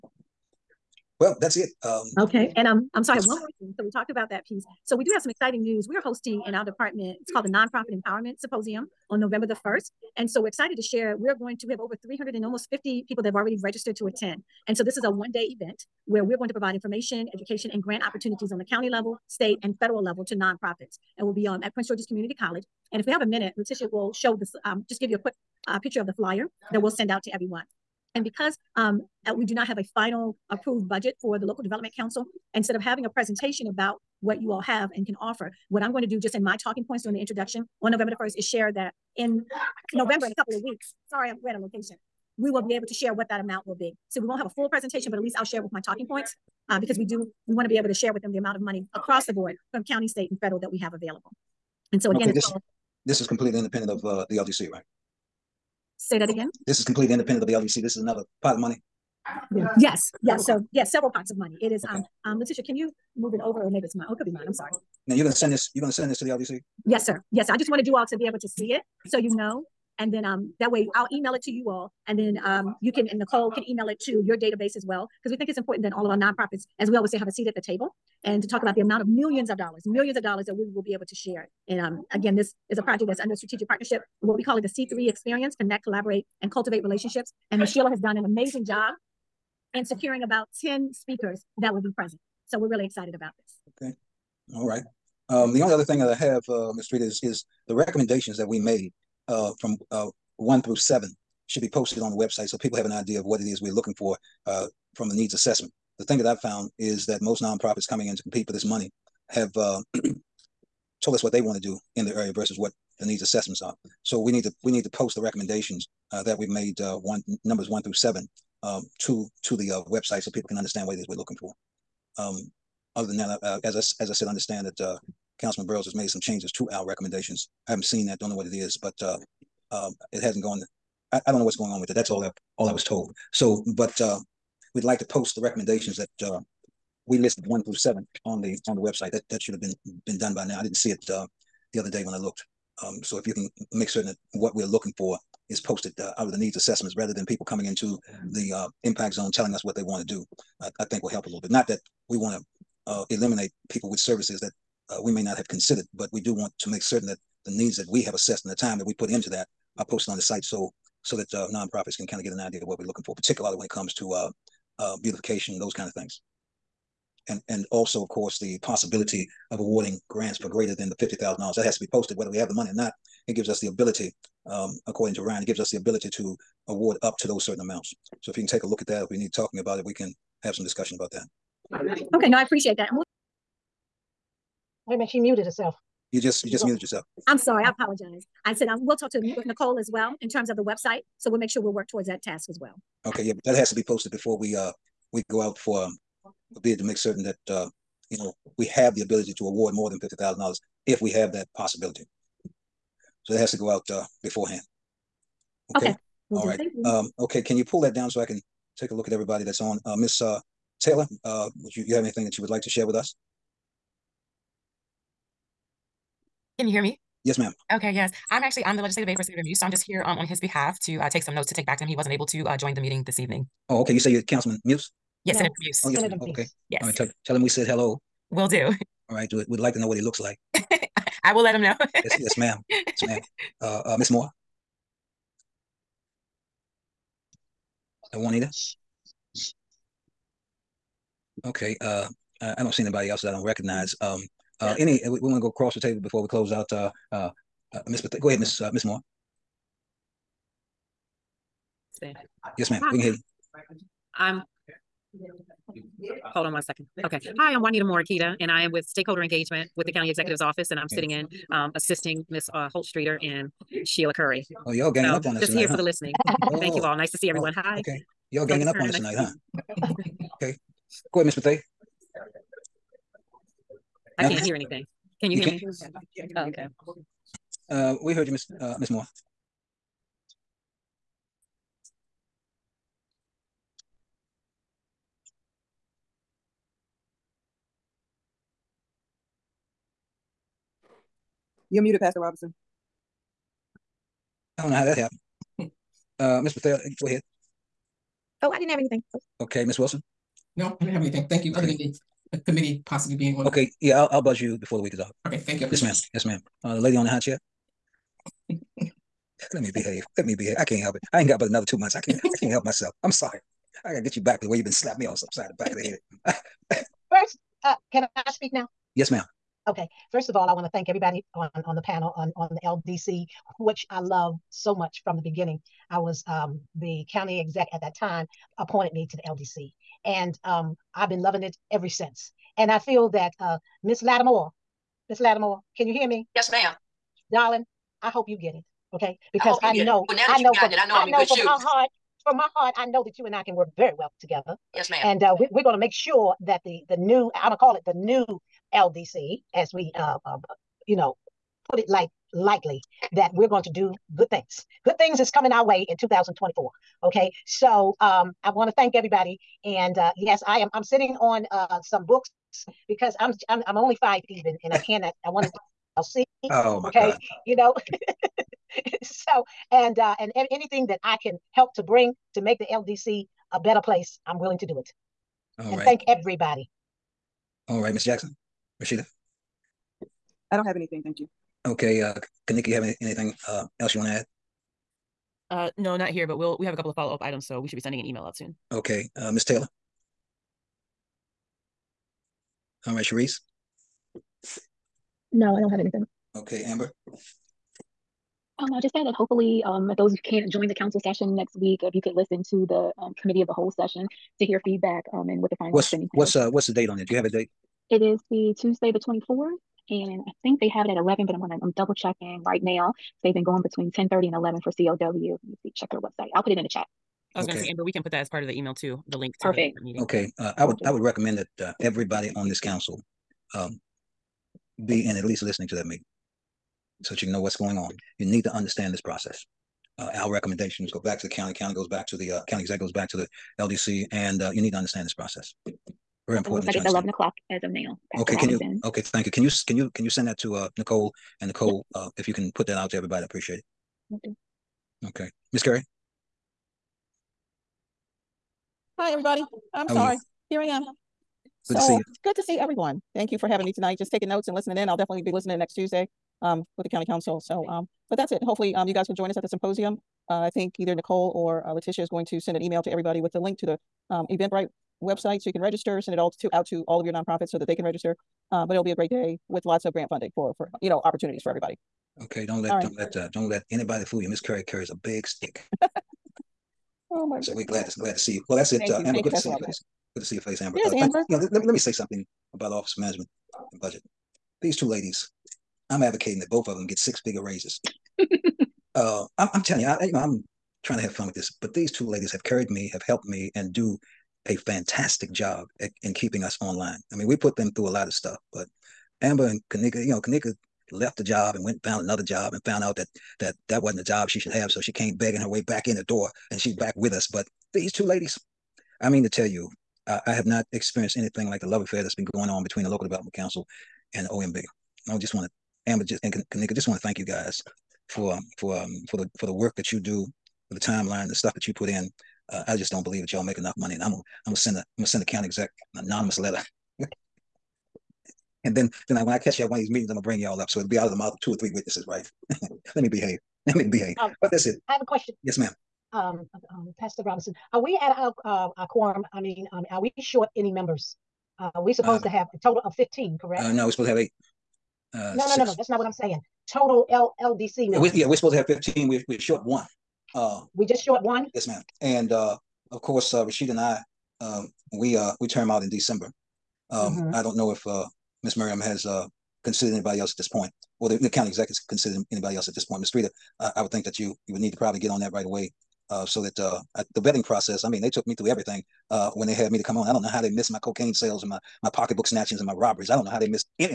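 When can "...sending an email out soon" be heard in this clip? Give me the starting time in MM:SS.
06:27.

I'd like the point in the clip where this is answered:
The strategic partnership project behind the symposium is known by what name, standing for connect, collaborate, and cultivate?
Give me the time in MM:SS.
01:24.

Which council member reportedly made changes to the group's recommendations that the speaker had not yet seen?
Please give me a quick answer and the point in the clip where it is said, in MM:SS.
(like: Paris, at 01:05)
Councilman Burroughs, at 02:05.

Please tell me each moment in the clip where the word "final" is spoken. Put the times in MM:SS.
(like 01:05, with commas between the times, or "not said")
00:29, 06:45.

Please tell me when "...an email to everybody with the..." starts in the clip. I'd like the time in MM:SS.
07:42.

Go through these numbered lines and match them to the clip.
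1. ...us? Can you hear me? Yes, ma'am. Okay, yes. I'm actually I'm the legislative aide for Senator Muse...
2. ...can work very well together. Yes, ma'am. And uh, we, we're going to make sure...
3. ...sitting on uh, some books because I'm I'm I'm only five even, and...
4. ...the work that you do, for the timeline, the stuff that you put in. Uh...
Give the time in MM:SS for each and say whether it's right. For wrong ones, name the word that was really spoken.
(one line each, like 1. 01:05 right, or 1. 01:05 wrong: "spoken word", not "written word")
1. 03:32 right
2. 05:43 right
3. 06:00 right
4. 08:39 right.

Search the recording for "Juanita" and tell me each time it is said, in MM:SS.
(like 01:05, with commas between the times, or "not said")
03:58, 04:17.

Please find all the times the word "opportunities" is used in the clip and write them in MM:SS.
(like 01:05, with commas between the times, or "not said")
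00:18, 07:51.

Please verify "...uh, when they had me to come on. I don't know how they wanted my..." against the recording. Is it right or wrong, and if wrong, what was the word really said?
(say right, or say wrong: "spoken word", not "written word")
wrong: "missed", not "wanted".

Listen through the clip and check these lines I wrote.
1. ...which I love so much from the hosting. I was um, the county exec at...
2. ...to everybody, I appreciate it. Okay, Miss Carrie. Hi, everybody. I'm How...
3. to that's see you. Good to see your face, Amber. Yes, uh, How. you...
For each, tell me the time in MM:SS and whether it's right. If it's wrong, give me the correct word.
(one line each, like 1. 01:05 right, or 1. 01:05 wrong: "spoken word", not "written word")
1. 05:23 wrong: "beginning", not "hosting"
2. 07:22 right
3. 07:59 wrong: "Amber", not "How".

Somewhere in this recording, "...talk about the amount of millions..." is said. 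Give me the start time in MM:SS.
01:18.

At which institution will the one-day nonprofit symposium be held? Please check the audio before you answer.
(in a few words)
Prince George's Community College.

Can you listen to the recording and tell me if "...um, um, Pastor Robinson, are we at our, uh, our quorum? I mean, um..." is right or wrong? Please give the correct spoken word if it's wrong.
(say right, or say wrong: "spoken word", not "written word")
right.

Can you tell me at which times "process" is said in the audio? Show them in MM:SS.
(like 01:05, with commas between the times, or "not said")
07:08, 07:15, 09:27.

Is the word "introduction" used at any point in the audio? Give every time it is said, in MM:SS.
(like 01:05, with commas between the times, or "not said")
00:37.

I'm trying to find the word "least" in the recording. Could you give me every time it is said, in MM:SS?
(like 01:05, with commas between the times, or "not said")
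00:45, 07:05.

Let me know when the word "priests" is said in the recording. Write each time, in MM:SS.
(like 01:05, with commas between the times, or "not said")
not said.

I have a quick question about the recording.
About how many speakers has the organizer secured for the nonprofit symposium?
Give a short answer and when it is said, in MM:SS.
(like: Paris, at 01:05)
10, at 01:30.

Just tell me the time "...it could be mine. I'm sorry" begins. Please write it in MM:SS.
01:04.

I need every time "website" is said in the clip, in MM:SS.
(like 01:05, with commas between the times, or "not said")
01:42, 01:59, 02:18, 03:10, 06:55, 07:45.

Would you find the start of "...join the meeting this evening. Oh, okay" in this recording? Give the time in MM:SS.
03:42.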